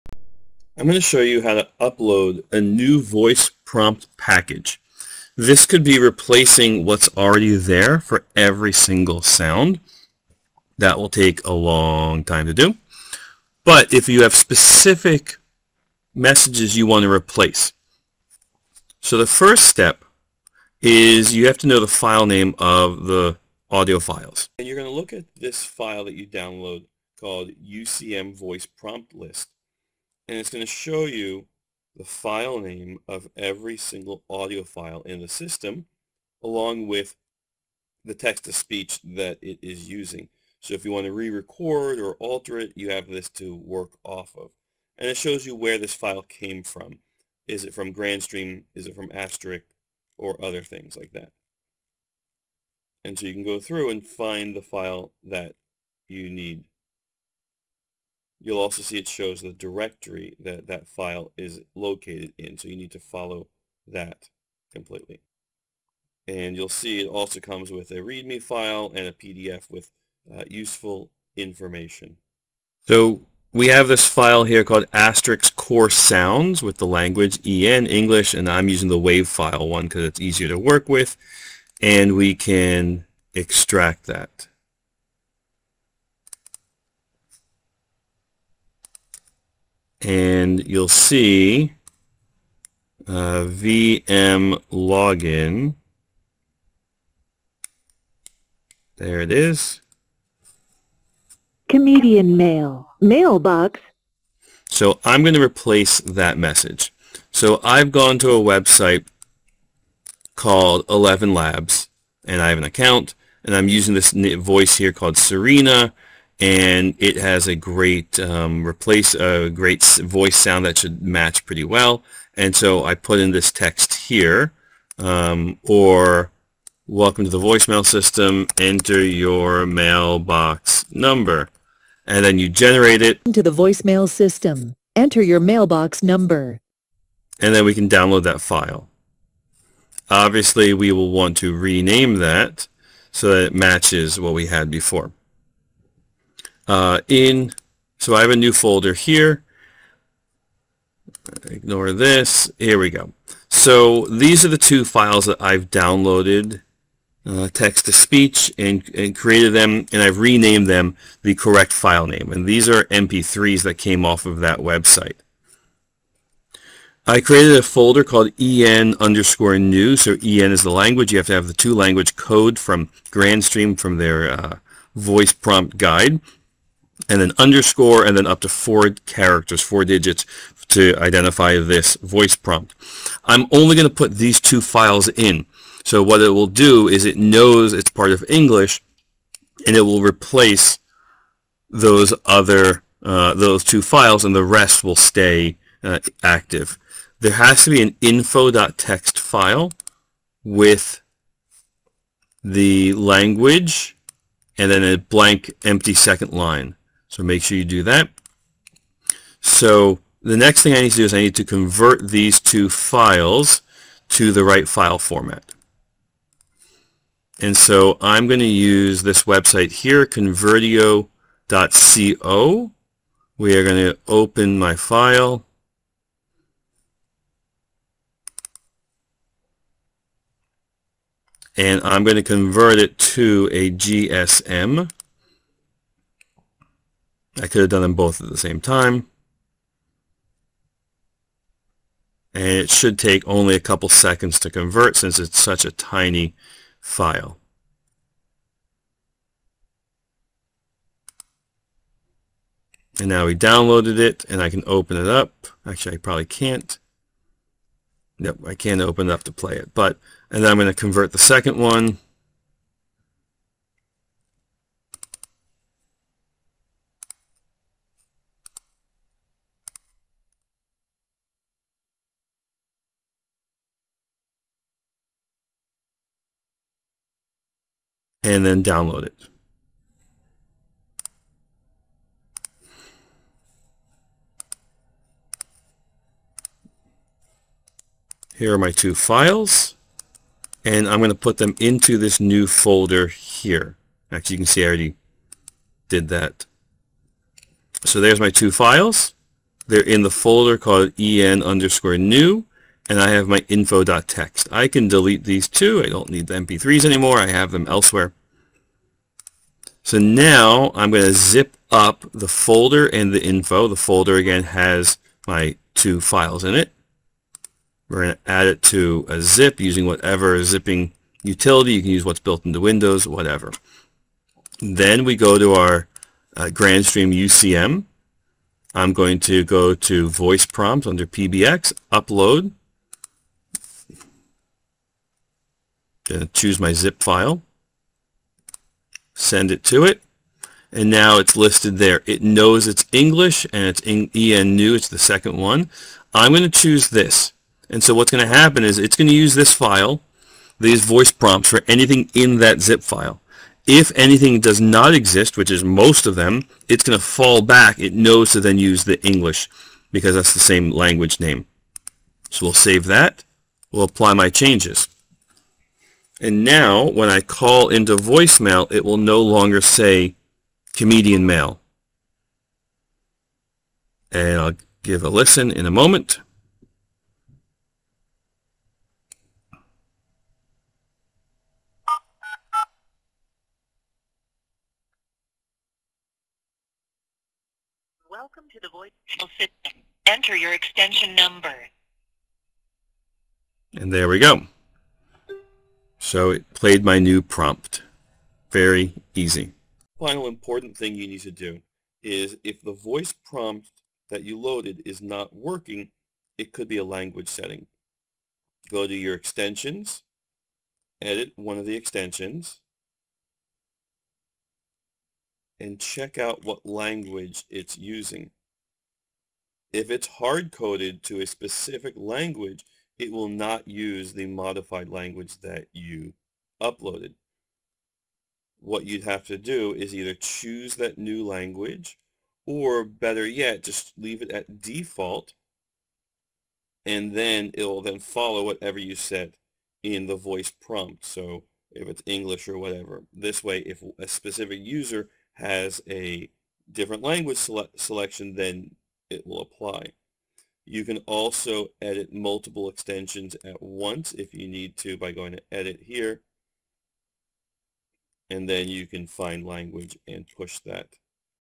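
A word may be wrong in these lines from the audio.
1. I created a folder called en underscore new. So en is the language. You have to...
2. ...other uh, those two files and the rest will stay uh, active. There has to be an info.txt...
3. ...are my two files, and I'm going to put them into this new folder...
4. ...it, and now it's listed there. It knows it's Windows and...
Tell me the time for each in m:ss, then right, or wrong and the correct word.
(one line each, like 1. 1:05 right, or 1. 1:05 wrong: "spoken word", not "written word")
1. 2:47 right
2. 3:12 right
3. 4:48 right
4. 5:39 wrong: "English", not "Windows".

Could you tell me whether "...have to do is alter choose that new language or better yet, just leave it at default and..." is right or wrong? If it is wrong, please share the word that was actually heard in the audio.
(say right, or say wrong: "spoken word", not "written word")
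wrong: "either", not "alter".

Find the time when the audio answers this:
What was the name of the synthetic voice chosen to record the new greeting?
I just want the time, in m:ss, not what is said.
1:55.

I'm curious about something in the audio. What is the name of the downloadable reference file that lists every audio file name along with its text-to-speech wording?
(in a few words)
UCM Voice Prompt List.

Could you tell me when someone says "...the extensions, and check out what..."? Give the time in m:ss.
6:51.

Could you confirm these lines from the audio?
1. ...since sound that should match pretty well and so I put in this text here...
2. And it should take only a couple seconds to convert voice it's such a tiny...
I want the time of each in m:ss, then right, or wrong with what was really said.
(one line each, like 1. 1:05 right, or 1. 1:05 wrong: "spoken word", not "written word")
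1. 2:00 wrong: "voice", not "since"
2. 4:02 wrong: "since", not "voice".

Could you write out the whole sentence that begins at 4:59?
They're in the folder called en underscore new and I have my info.txt.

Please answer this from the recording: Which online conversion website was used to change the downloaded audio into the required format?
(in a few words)
convertio.co.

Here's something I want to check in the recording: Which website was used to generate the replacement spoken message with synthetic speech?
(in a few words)
ElevenLabs.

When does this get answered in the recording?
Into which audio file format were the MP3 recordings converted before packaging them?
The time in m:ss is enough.
3:53.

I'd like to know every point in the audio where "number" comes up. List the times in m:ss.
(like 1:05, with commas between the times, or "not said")
2:10, 2:16, 6:31.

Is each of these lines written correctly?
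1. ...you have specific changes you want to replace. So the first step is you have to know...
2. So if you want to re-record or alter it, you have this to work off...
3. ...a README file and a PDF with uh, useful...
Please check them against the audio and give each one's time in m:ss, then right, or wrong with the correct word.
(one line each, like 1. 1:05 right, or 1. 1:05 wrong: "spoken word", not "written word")
1. 0:14 wrong: "messages", not "changes"
2. 0:40 right
3. 1:07 right.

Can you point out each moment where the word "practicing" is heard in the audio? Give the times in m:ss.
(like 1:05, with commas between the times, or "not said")
not said.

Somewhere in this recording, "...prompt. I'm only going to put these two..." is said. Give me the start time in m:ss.
3:02.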